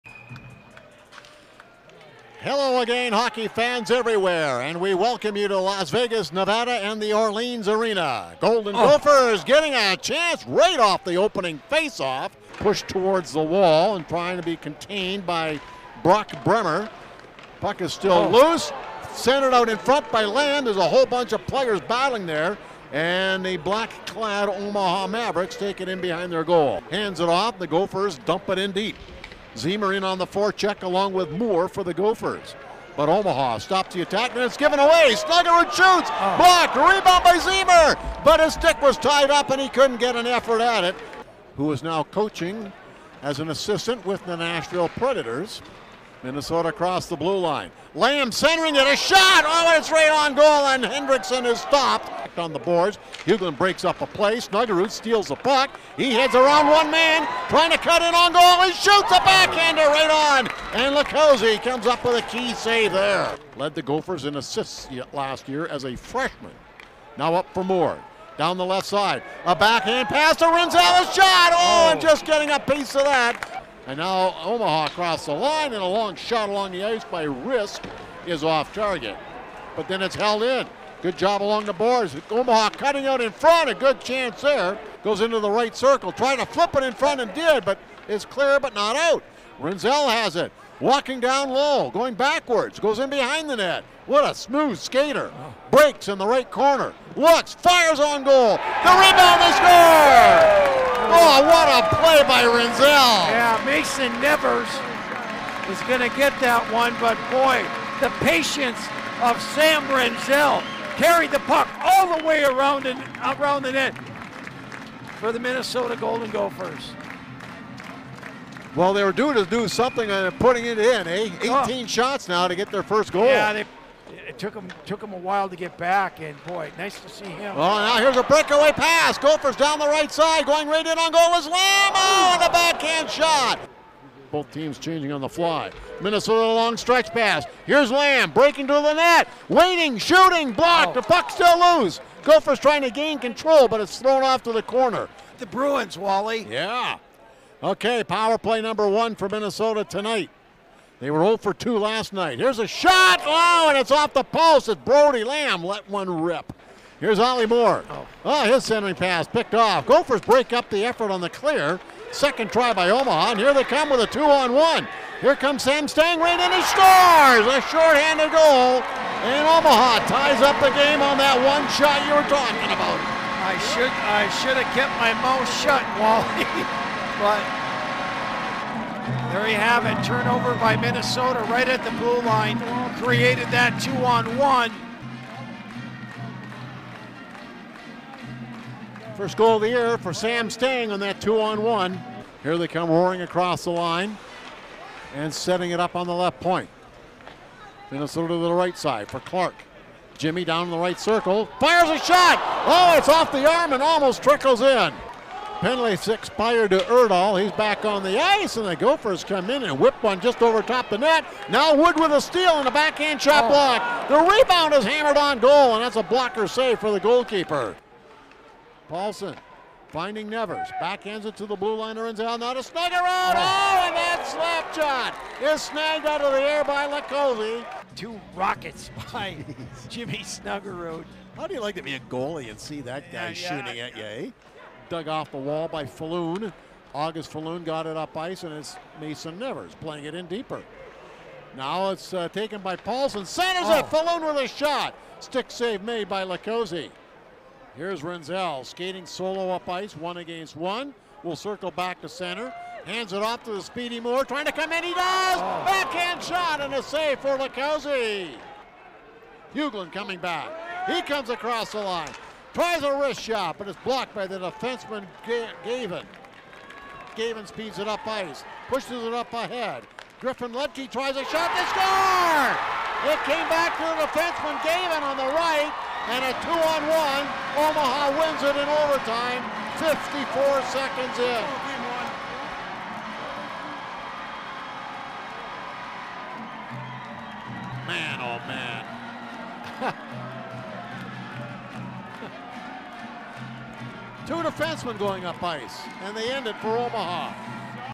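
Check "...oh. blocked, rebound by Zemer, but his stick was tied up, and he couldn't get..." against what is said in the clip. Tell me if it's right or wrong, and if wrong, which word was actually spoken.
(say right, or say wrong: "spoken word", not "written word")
right.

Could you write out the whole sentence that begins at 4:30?
Griffin Ledke tries a shot, they score!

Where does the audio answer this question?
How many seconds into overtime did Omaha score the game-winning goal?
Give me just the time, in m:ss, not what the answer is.
4:39.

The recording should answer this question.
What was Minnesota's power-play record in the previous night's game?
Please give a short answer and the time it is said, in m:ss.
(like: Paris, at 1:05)
0 for 2, at 2:31.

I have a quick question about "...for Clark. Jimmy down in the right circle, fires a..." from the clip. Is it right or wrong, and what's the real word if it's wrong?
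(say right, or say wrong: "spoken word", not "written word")
right.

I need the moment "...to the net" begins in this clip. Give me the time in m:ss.
2:18.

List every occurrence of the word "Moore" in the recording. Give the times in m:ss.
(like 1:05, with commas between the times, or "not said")
0:31, 2:37, 4:13.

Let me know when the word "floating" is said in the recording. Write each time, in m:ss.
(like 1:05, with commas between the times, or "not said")
not said.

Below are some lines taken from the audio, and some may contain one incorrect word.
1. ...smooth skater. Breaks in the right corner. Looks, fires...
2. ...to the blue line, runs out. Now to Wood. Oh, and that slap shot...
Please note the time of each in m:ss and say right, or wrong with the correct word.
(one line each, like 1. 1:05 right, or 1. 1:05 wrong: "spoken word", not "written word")
1. 1:34 right
2. 3:41 wrong: "Snuggerud", not "Wood".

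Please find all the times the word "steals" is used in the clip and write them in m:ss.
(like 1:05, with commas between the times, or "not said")
0:54, 3:32.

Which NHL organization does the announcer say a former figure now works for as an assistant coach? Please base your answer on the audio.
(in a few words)
Nashville Predators.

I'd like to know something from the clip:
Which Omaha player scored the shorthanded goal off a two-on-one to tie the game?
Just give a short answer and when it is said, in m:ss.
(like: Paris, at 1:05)
Sam Stangren, at 2:45.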